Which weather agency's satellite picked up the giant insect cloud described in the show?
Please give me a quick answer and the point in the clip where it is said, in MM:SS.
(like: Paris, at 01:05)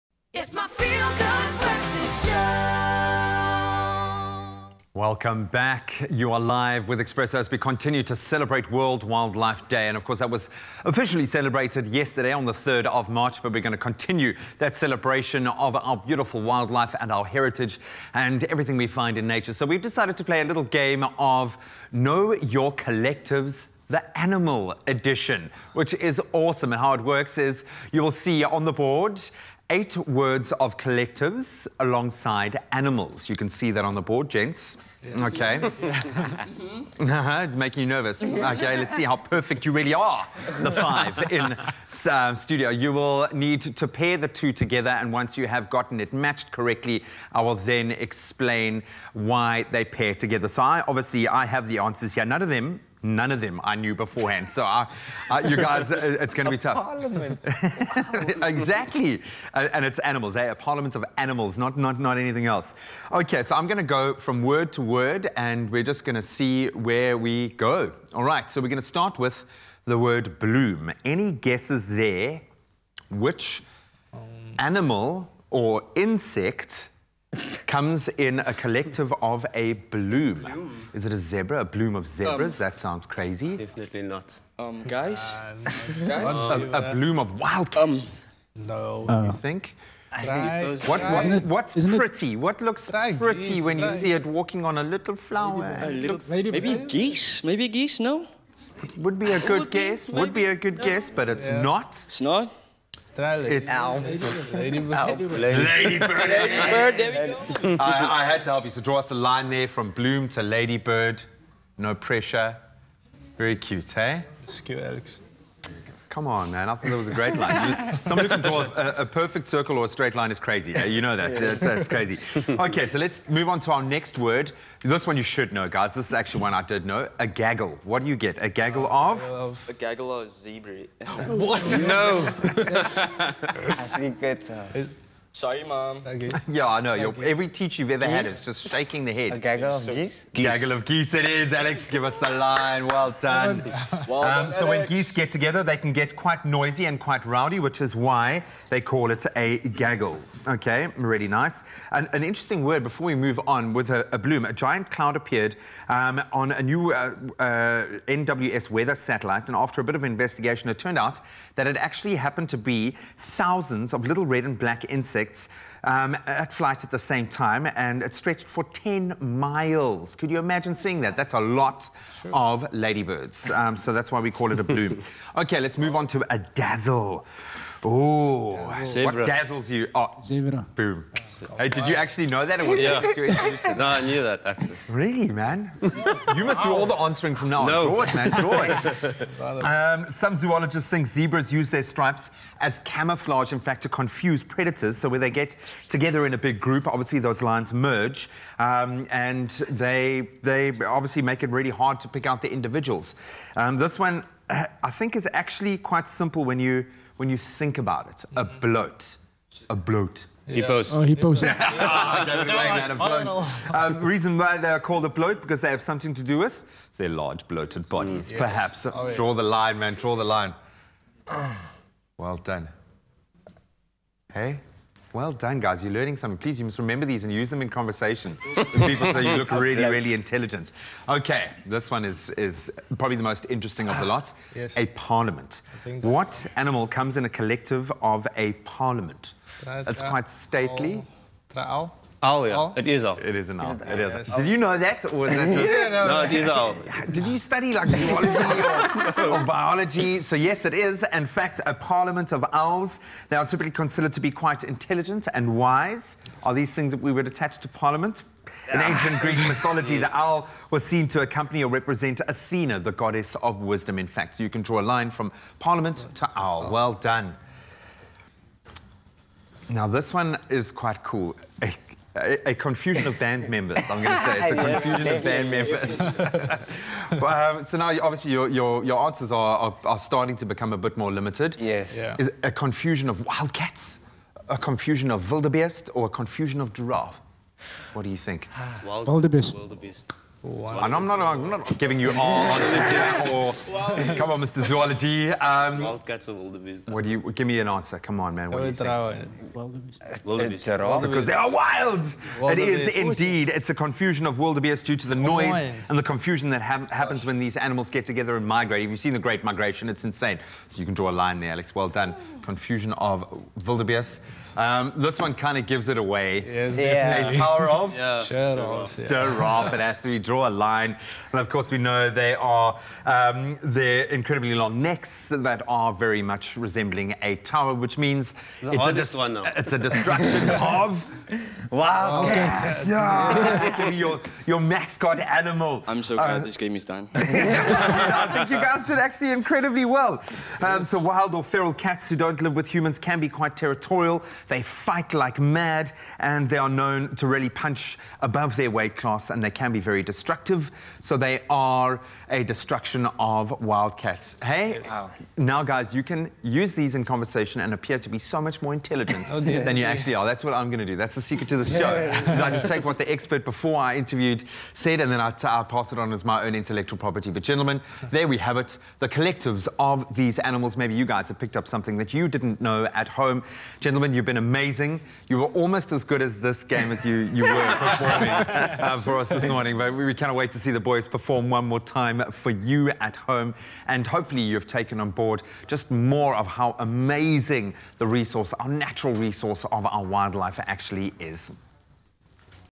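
NWS, at 02:38.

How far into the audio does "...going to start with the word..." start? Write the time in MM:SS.
01:08.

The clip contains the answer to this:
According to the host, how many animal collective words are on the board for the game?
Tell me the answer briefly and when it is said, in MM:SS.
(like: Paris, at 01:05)
8, at 00:29.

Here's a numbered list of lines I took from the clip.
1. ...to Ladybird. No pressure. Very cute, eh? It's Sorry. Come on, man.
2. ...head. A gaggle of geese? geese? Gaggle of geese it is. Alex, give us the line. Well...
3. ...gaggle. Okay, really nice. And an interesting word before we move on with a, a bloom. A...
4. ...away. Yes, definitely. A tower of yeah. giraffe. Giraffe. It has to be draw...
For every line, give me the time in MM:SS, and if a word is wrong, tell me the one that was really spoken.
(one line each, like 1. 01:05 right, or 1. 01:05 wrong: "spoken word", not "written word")
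1. 01:50 wrong: "Alex", not "Sorry"
2. 02:19 right
3. 02:29 right
4. 05:15 right.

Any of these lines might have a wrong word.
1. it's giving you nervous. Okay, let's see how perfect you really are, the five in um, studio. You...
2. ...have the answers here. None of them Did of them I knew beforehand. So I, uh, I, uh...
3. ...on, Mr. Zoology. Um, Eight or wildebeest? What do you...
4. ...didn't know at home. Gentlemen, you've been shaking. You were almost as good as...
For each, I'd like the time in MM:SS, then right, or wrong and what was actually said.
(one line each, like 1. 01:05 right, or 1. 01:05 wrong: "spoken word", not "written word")
1. 00:37 wrong: "making", not "giving"
2. 00:51 wrong: "None", not "Did"
3. 04:54 wrong: "Wildcats", not "Eight"
4. 06:12 wrong: "amazing", not "shaking".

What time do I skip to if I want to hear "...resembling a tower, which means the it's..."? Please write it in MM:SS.
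05:26.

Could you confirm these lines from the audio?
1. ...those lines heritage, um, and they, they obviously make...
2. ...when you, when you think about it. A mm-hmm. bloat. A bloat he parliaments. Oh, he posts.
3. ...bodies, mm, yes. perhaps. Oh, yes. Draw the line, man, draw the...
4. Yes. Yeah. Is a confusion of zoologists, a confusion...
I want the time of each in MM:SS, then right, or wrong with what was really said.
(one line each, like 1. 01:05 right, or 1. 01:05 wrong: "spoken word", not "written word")
1. 03:17 wrong: "merge", not "heritage"
2. 03:26 wrong: "posts", not "parliaments"
3. 03:37 right
4. 04:41 wrong: "wildcats", not "zoologists".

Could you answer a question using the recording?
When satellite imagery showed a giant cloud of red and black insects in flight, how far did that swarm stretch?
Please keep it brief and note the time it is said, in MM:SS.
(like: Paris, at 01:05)
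10 miles, at 02:48.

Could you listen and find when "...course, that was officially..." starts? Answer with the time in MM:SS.
00:10.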